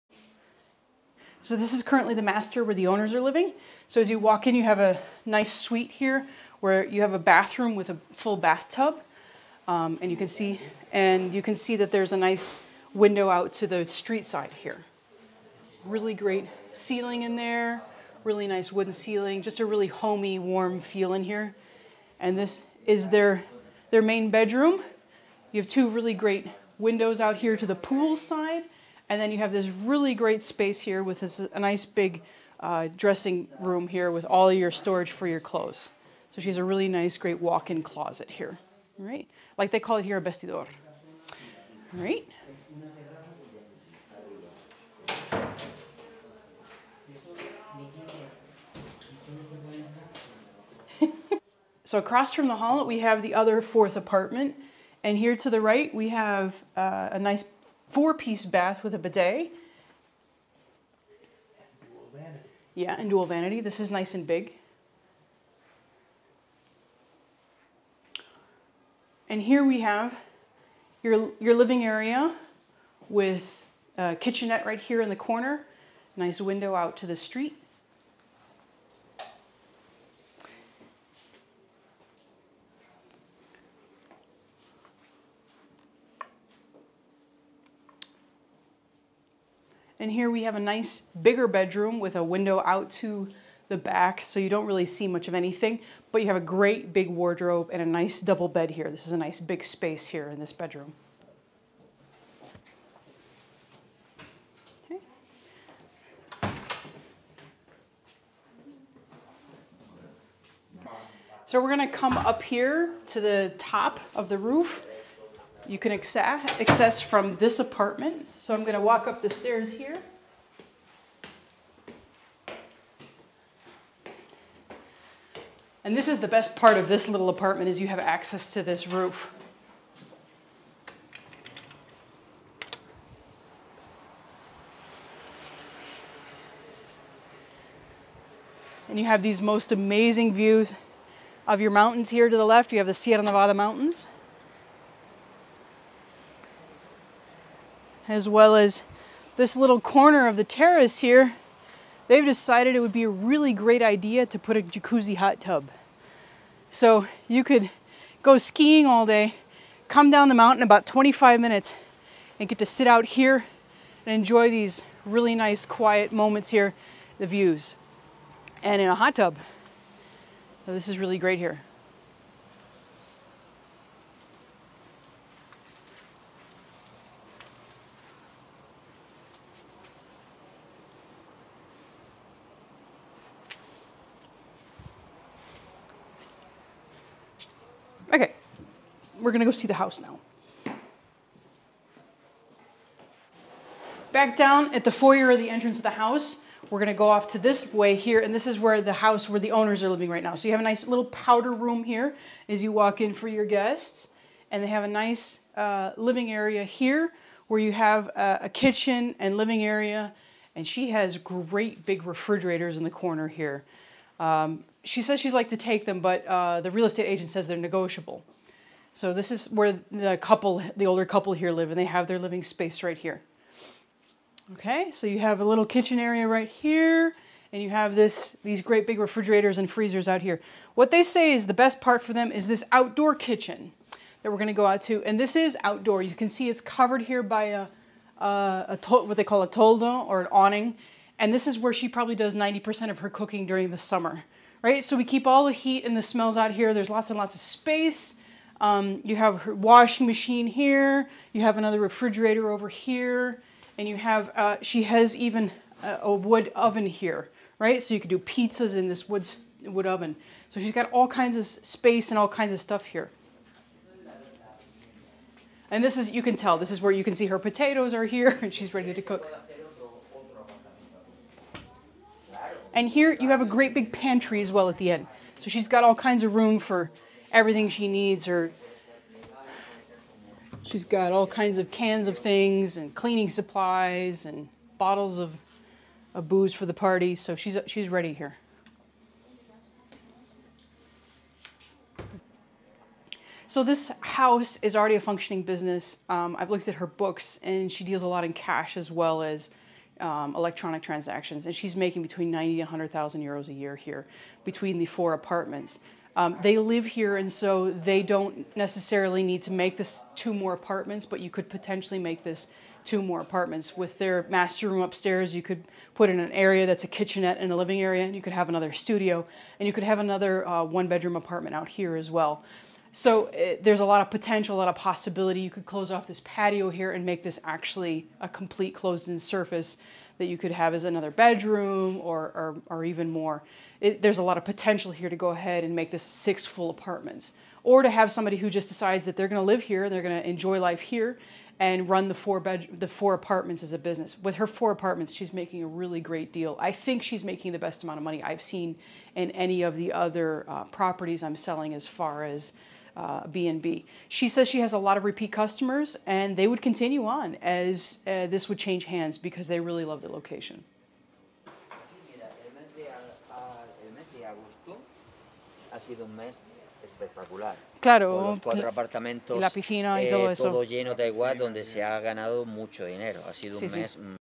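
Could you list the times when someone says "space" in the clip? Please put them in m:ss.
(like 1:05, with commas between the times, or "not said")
0:30, 1:39, 3:42, 4:07, 4:21.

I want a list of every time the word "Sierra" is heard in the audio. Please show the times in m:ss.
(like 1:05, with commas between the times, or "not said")
2:22.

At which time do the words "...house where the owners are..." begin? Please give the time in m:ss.
3:18.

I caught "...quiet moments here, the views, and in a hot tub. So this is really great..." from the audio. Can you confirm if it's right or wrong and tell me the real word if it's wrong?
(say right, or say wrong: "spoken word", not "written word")
right.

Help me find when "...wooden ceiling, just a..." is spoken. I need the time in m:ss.
0:18.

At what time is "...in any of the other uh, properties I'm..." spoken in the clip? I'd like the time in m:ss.
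5:49.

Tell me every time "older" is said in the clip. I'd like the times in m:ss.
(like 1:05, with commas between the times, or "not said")
3:40.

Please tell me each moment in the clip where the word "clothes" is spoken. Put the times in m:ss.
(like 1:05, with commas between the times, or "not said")
0:35.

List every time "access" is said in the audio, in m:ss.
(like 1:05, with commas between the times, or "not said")
1:55, 2:07.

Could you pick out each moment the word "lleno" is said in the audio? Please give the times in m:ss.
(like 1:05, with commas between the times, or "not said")
6:10.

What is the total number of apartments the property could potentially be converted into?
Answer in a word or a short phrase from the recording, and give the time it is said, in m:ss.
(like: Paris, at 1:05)
6, at 5:36.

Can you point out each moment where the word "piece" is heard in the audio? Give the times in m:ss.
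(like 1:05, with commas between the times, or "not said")
0:57.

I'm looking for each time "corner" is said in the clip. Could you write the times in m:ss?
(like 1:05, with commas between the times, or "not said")
1:15, 2:29, 3:32.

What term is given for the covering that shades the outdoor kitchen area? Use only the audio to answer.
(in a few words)
toldo.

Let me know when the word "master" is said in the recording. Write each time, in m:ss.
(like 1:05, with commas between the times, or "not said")
0:02, 5:14.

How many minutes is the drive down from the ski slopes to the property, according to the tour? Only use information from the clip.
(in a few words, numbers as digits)
25 minutes.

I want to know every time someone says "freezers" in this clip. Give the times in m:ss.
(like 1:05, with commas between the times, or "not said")
3:49.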